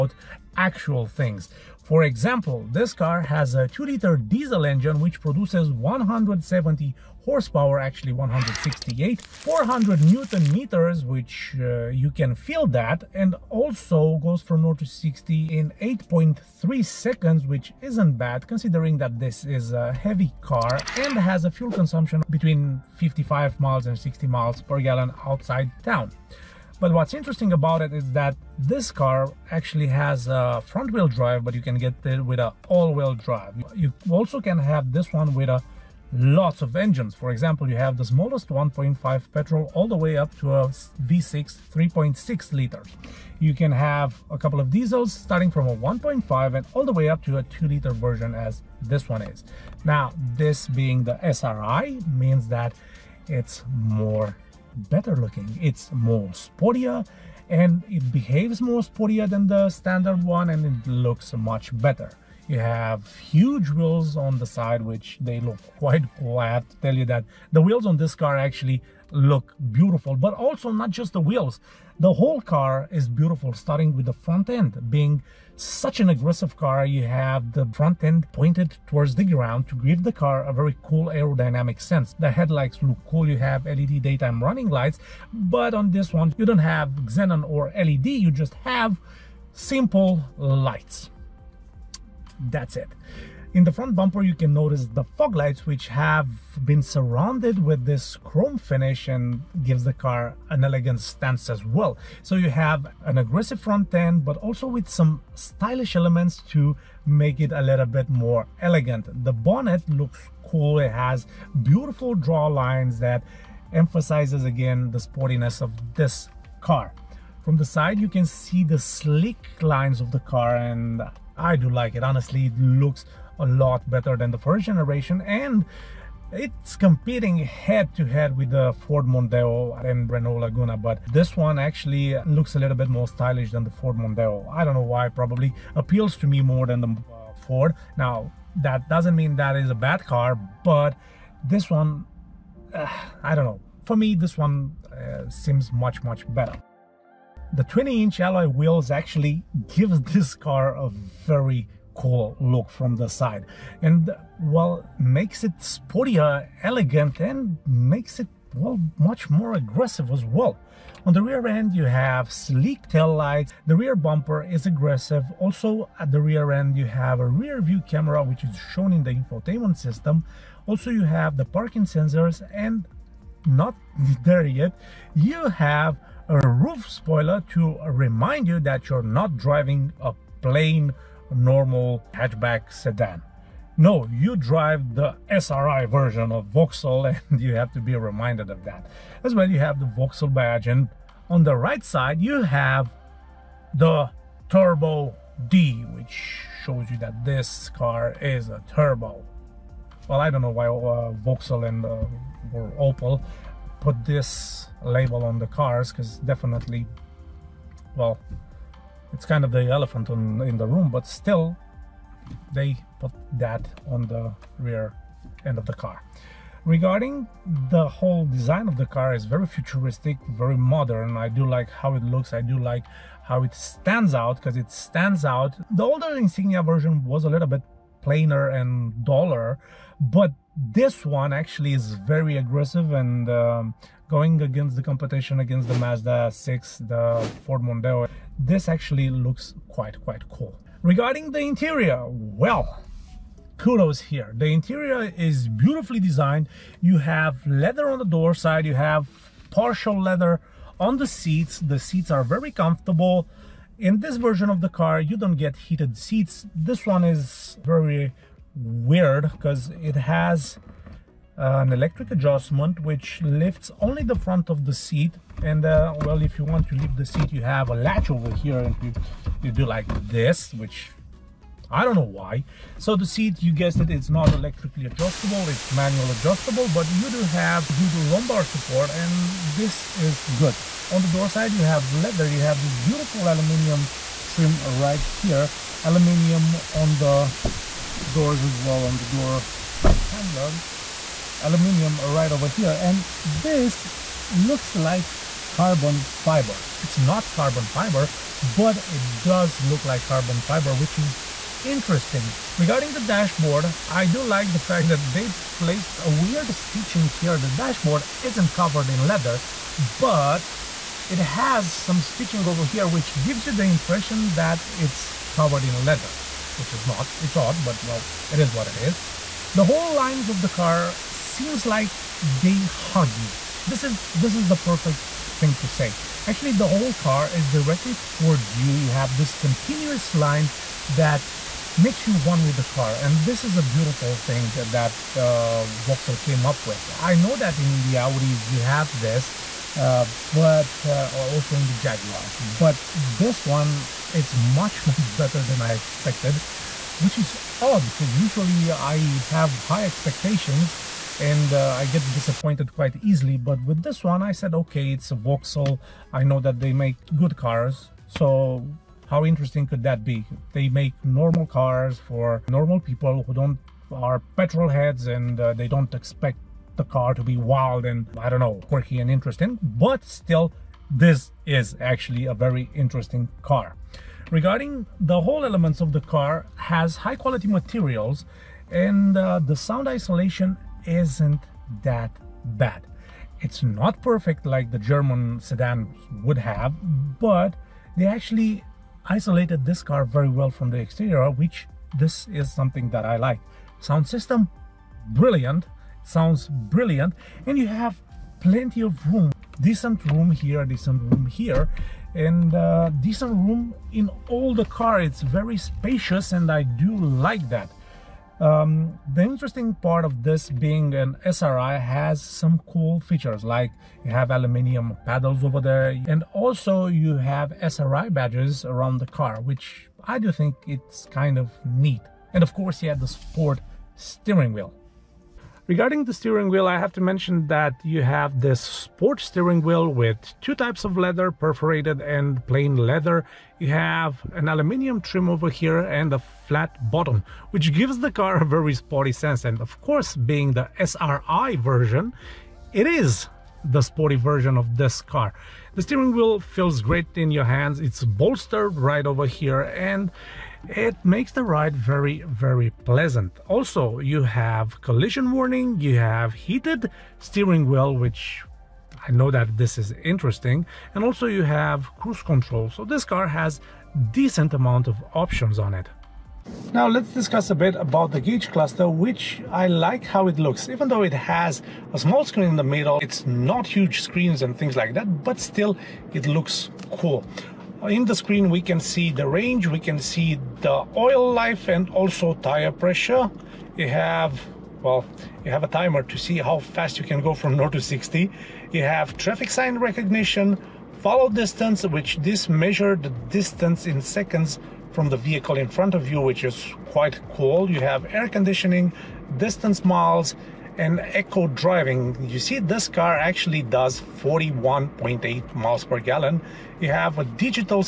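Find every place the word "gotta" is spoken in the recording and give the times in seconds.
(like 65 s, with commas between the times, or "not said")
not said.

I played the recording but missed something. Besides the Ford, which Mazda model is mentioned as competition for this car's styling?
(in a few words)
Mazda 6.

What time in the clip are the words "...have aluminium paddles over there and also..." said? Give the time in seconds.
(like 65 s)
414 s.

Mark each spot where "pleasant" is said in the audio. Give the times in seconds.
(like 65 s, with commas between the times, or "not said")
452 s.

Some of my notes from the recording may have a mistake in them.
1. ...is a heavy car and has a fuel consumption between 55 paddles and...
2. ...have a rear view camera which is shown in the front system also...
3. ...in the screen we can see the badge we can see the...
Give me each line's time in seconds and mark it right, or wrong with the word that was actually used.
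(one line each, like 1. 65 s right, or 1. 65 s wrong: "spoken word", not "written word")
1. 19 s wrong: "miles", not "paddles"
2. 166 s wrong: "infotainment", not "front"
3. 477 s wrong: "range", not "badge".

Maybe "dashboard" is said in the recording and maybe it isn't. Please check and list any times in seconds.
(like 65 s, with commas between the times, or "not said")
303 s, 307 s.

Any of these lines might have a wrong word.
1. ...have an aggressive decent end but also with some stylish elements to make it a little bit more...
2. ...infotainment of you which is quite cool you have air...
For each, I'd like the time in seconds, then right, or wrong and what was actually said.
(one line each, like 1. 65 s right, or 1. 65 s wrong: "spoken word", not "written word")
1. 102 s wrong: "front", not "decent"
2. 495 s wrong: "front", not "infotainment".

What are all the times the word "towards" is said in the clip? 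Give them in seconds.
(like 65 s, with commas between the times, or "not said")
78 s, 328 s.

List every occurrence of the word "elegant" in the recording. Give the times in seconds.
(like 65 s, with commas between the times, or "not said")
100 s, 108 s, 156 s.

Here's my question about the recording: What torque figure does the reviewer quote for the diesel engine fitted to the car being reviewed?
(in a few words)
400 newton meters.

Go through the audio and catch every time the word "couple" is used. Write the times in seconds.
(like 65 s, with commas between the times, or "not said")
44 s.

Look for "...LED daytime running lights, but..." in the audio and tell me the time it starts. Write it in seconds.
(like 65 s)
83 s.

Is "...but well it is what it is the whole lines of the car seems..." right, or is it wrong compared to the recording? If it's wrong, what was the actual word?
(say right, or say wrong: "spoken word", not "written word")
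right.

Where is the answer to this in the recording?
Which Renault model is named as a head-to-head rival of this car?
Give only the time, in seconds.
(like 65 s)
130 s.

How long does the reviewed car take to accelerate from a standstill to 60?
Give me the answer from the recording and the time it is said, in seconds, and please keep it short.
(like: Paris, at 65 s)
8.3 seconds, at 15 s.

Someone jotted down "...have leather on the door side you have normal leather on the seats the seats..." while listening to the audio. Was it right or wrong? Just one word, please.
wrong.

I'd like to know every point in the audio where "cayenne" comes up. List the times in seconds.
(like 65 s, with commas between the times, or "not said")
not said.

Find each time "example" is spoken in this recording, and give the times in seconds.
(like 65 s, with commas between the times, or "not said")
2 s, 37 s.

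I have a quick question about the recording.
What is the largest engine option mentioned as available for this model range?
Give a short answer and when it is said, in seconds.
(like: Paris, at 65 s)
V6 3.6 liters, at 41 s.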